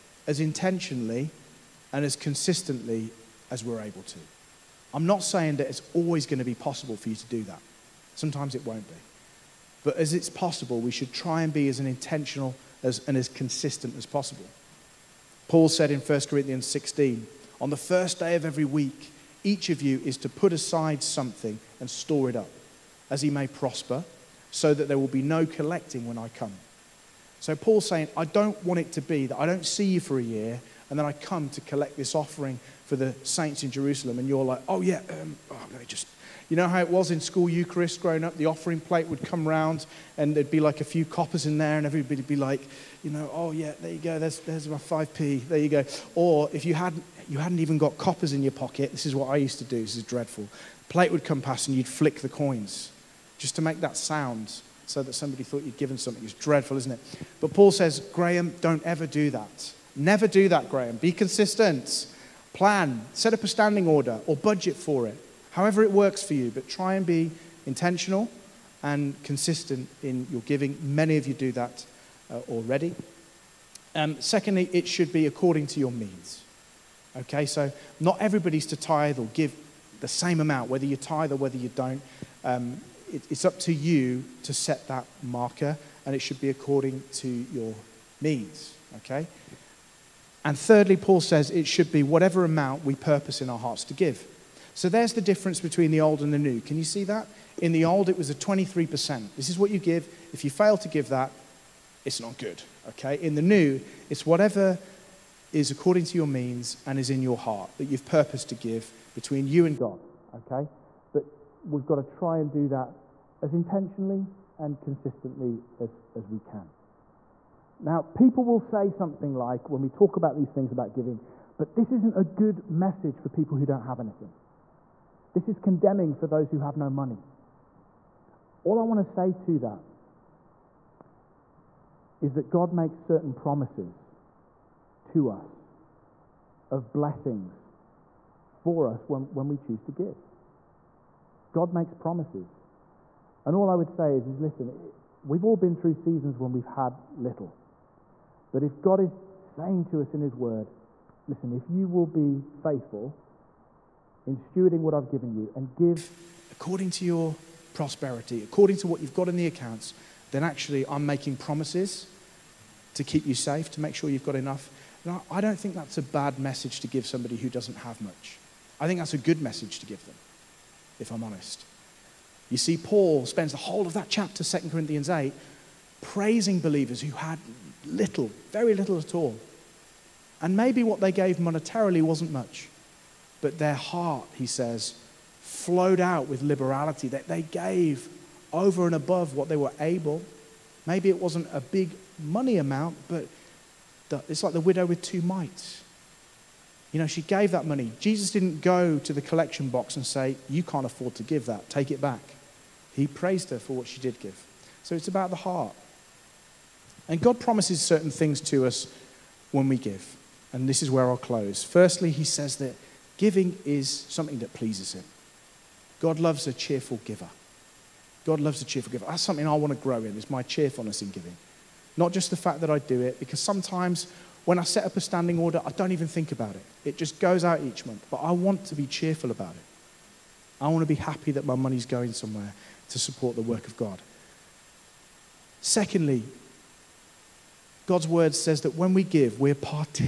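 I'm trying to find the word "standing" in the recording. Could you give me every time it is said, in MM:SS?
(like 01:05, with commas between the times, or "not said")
01:03, 03:45.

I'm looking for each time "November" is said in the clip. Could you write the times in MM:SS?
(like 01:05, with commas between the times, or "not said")
not said.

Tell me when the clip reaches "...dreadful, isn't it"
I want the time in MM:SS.
00:56.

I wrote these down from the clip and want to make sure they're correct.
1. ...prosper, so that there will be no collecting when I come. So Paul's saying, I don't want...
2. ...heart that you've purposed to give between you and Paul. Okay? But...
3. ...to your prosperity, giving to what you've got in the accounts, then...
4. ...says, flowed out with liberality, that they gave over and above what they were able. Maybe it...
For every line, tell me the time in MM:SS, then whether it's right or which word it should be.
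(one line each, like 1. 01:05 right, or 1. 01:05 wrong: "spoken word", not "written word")
1. 00:23 right
2. 01:47 wrong: "God", not "Paul"
3. 02:36 wrong: "according", not "giving"
4. 03:04 right.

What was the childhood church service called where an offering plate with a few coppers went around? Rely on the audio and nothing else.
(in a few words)
school Eucharist.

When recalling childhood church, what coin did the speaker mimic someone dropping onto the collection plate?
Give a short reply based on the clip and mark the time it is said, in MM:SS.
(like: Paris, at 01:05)
5p, at 00:44.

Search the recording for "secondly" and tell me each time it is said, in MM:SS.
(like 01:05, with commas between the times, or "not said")
01:14, 03:55.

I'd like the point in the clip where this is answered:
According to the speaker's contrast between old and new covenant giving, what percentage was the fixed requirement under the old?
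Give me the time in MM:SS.
01:38.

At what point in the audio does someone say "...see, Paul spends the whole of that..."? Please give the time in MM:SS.
02:52.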